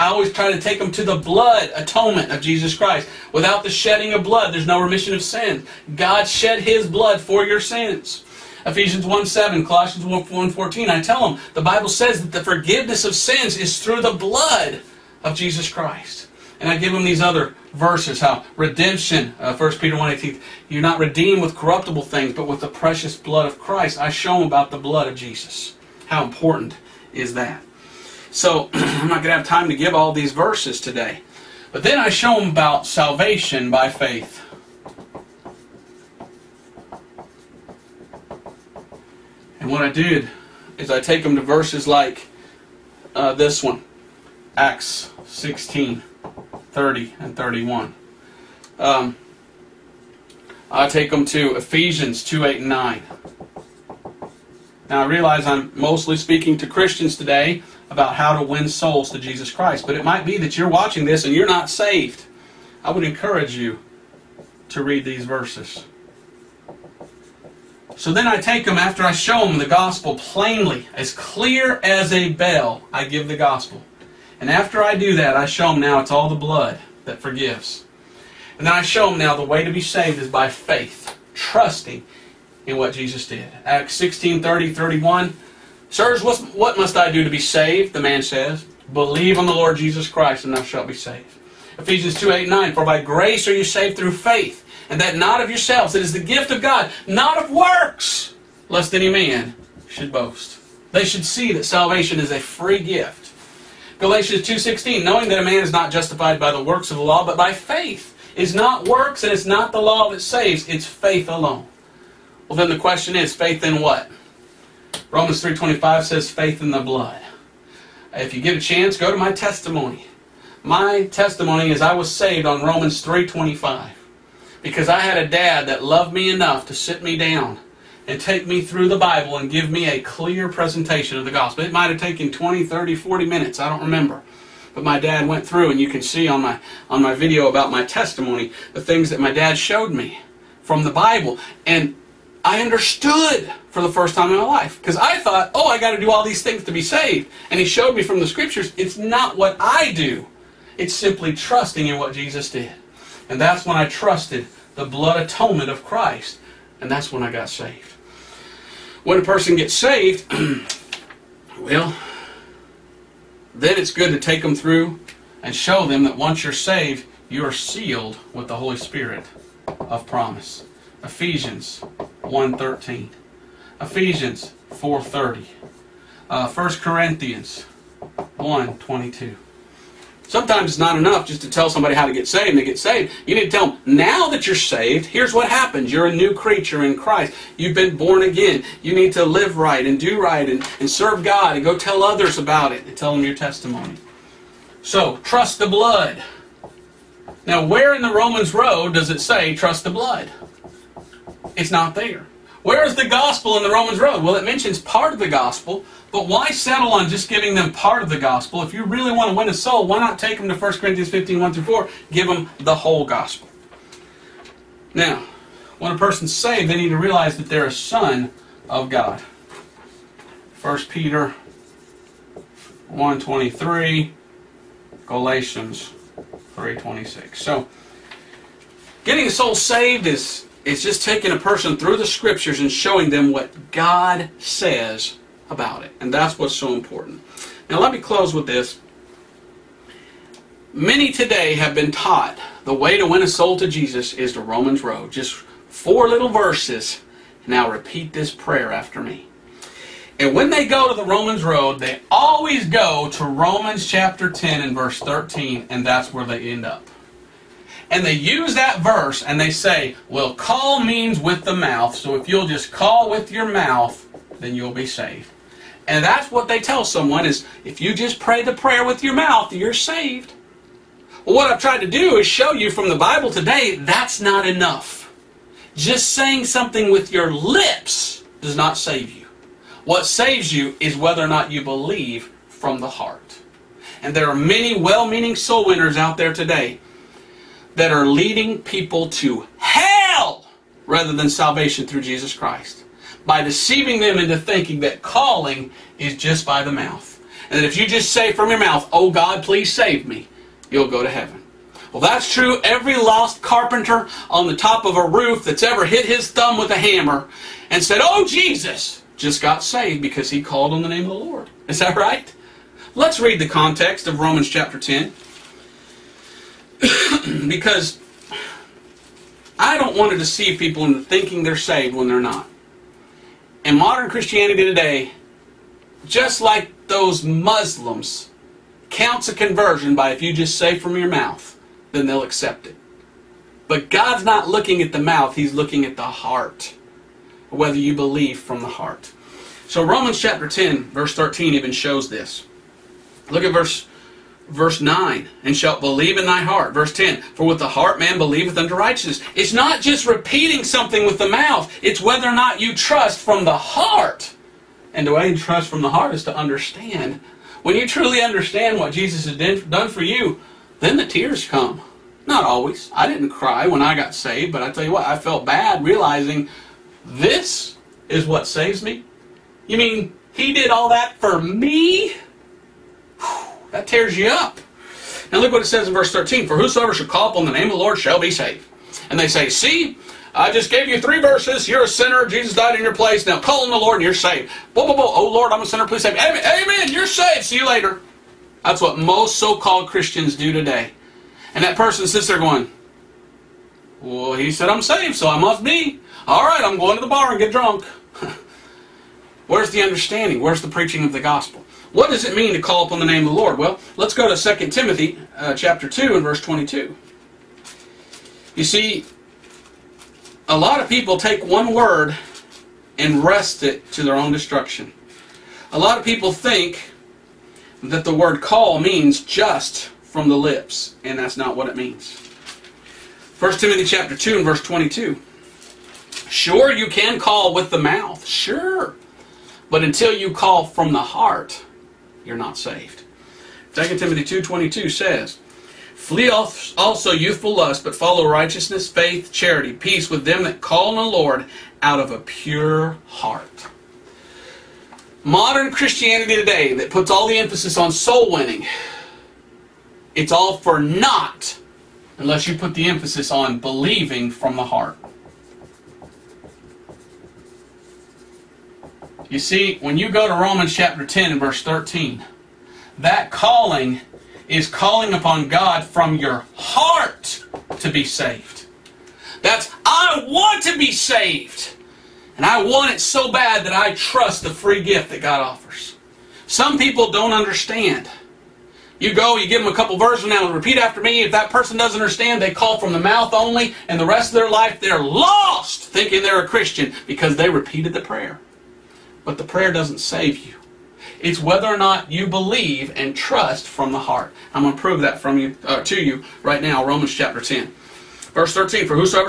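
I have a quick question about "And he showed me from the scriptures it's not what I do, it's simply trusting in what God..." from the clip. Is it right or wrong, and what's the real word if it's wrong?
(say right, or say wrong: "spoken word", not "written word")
wrong: "Jesus", not "God".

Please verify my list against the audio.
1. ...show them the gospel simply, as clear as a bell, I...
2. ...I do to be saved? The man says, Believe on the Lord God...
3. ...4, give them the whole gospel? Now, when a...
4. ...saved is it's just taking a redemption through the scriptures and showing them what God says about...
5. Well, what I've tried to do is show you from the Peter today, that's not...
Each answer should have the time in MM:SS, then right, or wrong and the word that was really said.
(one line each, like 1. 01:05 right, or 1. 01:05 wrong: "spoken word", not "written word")
1. 01:09 wrong: "plainly", not "simply"
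2. 01:26 wrong: "Jesus", not "God"
3. 03:31 right
4. 03:49 wrong: "person", not "redemption"
5. 04:31 wrong: "Bible", not "Peter".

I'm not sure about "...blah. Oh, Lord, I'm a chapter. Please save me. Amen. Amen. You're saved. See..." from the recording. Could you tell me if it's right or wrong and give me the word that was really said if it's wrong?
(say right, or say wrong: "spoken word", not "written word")
wrong: "sinner", not "chapter".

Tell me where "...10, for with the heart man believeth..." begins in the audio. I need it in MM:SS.
05:46.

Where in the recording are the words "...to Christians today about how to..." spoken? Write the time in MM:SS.
00:56.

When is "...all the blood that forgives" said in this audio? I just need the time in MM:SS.
01:16.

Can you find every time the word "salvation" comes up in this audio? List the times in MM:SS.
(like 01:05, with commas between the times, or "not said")
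00:32, 01:41, 04:51.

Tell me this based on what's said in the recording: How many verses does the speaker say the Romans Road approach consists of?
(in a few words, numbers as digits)
4.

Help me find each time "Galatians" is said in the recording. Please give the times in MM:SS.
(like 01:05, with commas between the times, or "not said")
01:44, 03:45.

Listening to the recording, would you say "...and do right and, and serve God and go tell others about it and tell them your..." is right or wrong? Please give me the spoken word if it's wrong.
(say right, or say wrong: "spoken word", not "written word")
right.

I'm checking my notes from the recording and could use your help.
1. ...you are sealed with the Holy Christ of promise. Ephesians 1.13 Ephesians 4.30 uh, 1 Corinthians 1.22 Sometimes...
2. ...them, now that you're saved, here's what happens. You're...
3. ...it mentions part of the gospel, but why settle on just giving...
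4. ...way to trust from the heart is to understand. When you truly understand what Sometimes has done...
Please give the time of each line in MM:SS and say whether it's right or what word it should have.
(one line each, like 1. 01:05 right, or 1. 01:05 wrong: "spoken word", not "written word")
1. 02:47 wrong: "Spirit", not "Christ"
2. 03:03 right
3. 03:24 right
4. 05:55 wrong: "Jesus", not "Sometimes".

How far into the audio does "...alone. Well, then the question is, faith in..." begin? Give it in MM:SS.
01:51.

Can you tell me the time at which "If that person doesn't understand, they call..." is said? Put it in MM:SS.
08:01.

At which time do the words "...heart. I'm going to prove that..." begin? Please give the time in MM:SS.
08:13.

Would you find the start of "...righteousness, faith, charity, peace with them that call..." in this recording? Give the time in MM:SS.
07:18.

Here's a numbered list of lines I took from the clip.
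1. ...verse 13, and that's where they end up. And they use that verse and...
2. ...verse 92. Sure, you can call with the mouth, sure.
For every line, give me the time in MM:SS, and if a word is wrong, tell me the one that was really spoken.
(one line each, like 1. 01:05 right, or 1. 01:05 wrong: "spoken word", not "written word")
1. 04:14 right
2. 07:04 wrong: "22", not "92".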